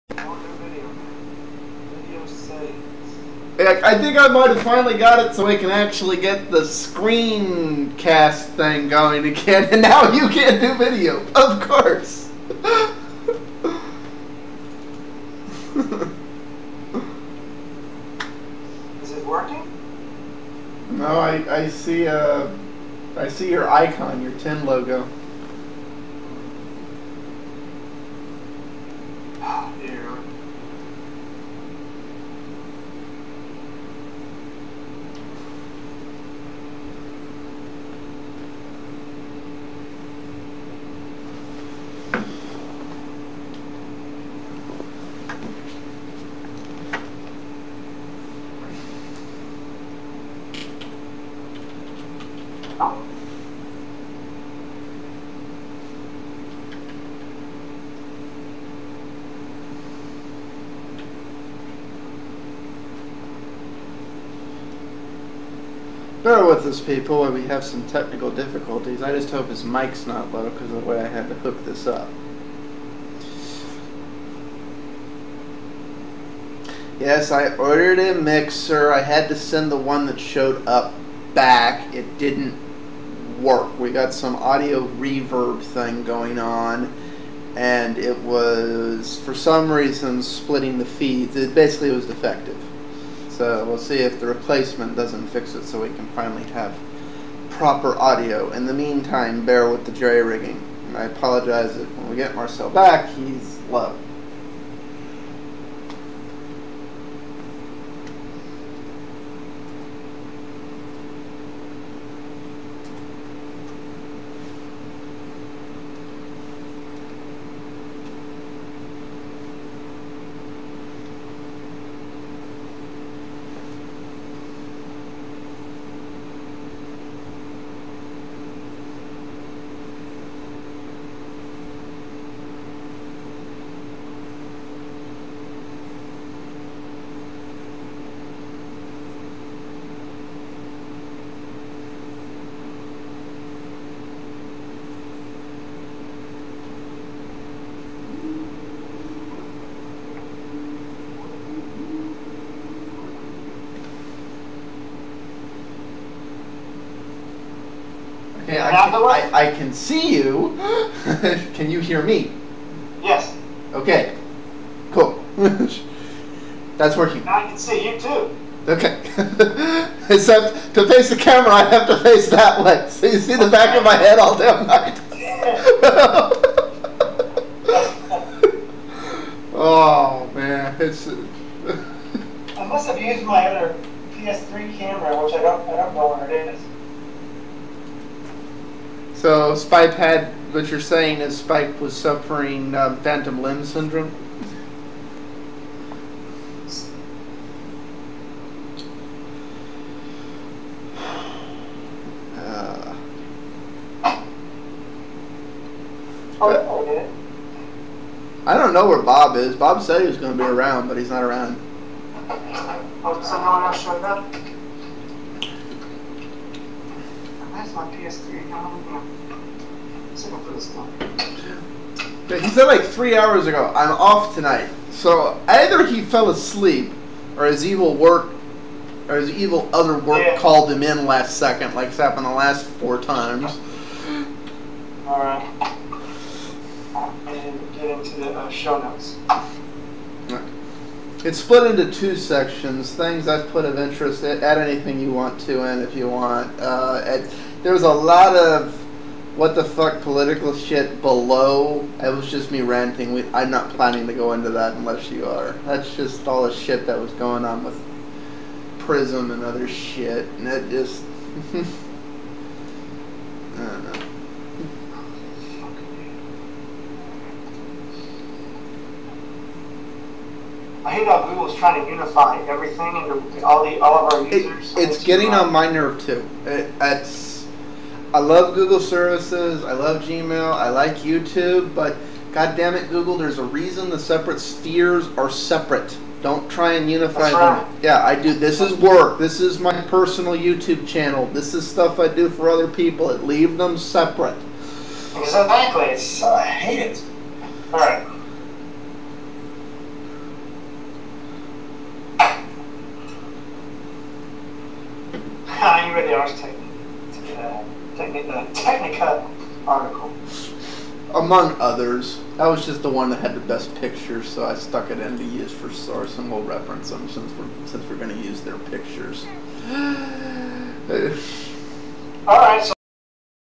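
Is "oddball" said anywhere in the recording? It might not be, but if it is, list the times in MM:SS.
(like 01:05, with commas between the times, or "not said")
not said.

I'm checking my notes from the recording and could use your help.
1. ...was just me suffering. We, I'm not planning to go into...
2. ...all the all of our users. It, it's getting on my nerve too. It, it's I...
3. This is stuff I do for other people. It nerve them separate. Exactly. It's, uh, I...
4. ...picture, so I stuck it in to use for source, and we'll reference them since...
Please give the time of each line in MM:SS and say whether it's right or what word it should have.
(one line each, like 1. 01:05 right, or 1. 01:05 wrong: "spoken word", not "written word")
1. 04:12 wrong: "ranting", not "suffering"
2. 04:33 right
3. 04:51 wrong: "leave", not "nerve"
4. 05:13 right.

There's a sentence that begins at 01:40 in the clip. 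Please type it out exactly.
And I apologize if when we get Marcel back, he's low.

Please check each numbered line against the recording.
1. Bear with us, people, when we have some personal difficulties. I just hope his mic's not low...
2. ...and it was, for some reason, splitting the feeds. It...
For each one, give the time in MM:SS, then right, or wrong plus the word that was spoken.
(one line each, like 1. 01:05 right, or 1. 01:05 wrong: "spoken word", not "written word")
1. 01:06 wrong: "technical", not "personal"
2. 01:27 right.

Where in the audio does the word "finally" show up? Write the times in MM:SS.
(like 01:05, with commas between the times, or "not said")
00:04, 01:36.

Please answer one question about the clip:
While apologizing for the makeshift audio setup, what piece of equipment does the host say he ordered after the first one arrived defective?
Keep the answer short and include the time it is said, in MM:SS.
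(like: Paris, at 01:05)
A mixer, at 01:18.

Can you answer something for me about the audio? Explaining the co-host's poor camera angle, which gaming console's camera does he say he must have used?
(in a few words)
PS3.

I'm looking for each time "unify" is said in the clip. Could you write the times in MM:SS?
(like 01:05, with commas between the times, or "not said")
04:31, 04:46.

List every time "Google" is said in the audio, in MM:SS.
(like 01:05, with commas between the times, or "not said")
04:31, 04:38, 04:42.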